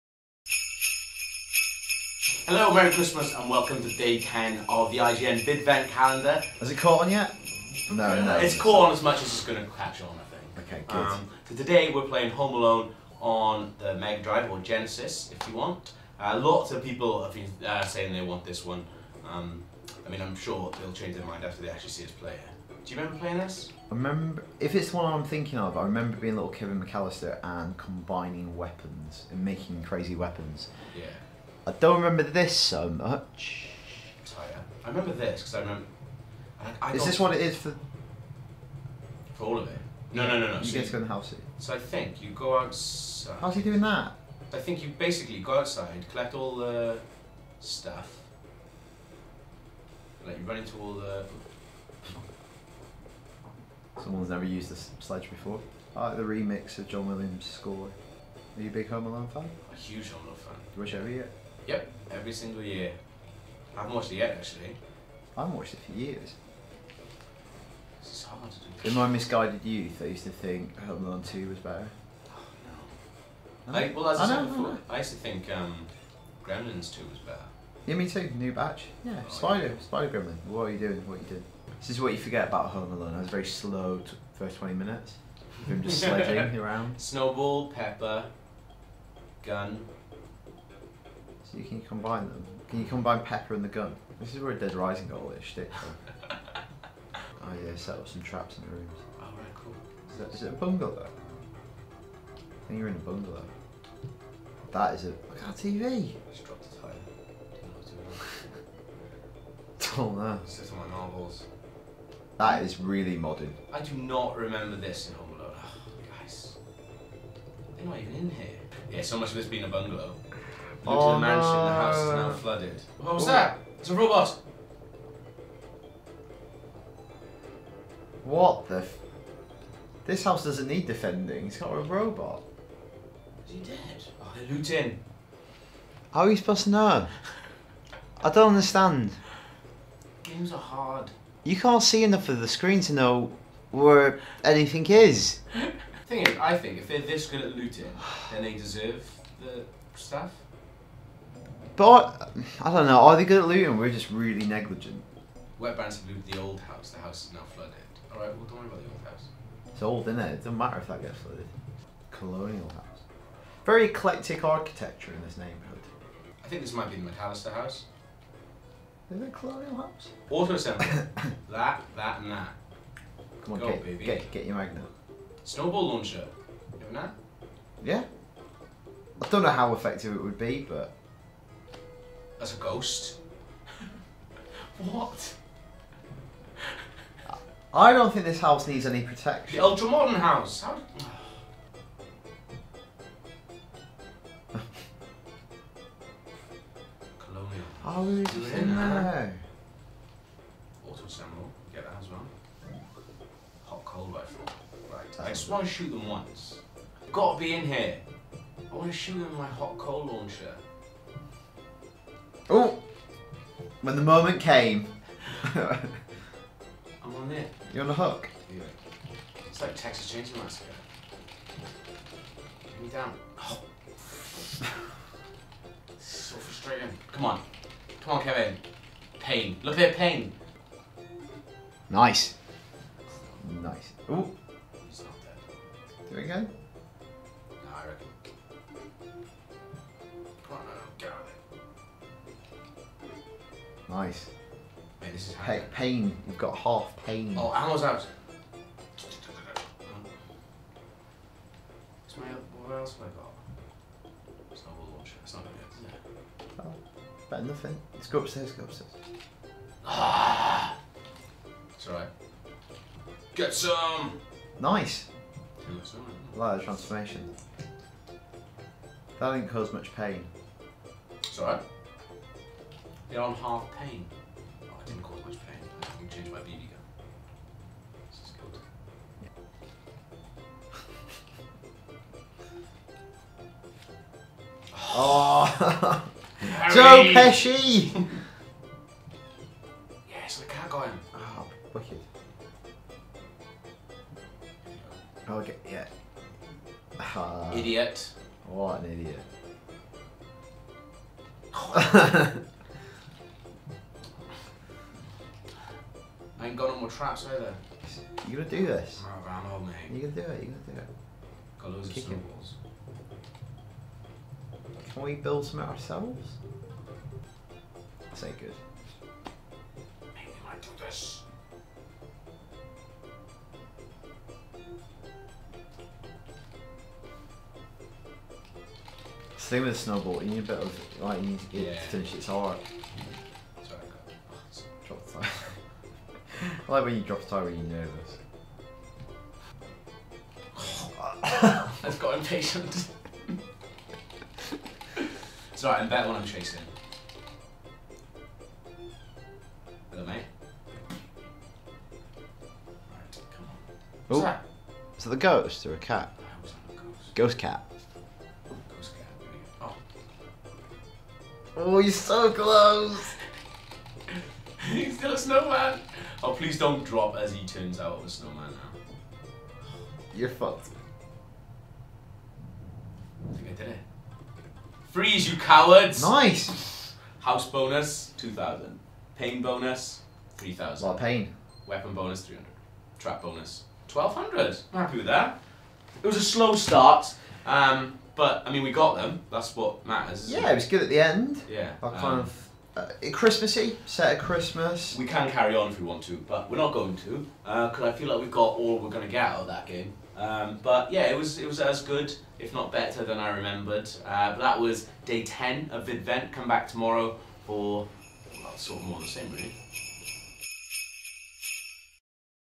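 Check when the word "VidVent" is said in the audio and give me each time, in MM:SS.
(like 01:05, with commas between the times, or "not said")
00:05, 06:45.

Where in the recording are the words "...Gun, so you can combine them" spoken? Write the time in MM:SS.
01:29.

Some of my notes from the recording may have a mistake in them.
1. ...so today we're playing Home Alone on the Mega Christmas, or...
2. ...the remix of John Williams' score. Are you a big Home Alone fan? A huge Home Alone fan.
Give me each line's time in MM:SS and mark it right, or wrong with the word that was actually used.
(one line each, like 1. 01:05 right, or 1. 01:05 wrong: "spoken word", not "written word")
1. 00:11 wrong: "Drive", not "Christmas"
2. 00:56 right.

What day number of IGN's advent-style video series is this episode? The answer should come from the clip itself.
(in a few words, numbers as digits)
10.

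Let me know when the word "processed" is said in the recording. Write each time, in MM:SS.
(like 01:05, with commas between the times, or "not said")
not said.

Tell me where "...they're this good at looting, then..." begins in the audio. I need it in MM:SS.
02:26.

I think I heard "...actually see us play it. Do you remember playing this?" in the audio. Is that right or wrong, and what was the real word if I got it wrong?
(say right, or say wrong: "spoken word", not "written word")
right.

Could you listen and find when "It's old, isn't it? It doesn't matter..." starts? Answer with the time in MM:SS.
02:39.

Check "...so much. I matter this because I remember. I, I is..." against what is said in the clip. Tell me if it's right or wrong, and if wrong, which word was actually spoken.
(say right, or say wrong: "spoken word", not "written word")
wrong: "remember", not "matter".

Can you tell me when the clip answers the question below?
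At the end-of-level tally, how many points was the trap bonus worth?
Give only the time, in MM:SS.
06:23.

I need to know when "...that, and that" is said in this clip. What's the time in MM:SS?
02:51.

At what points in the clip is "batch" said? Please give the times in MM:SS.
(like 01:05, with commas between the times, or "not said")
01:18.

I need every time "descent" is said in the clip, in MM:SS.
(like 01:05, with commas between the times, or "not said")
not said.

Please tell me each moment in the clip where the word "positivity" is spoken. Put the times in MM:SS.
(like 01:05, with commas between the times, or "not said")
not said.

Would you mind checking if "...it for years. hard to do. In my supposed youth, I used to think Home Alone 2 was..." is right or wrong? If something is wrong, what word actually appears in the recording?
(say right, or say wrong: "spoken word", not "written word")
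wrong: "misguided", not "supposed".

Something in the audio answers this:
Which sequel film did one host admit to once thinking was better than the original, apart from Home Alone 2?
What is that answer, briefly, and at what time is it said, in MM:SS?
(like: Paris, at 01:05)
Gremlins 2, at 01:16.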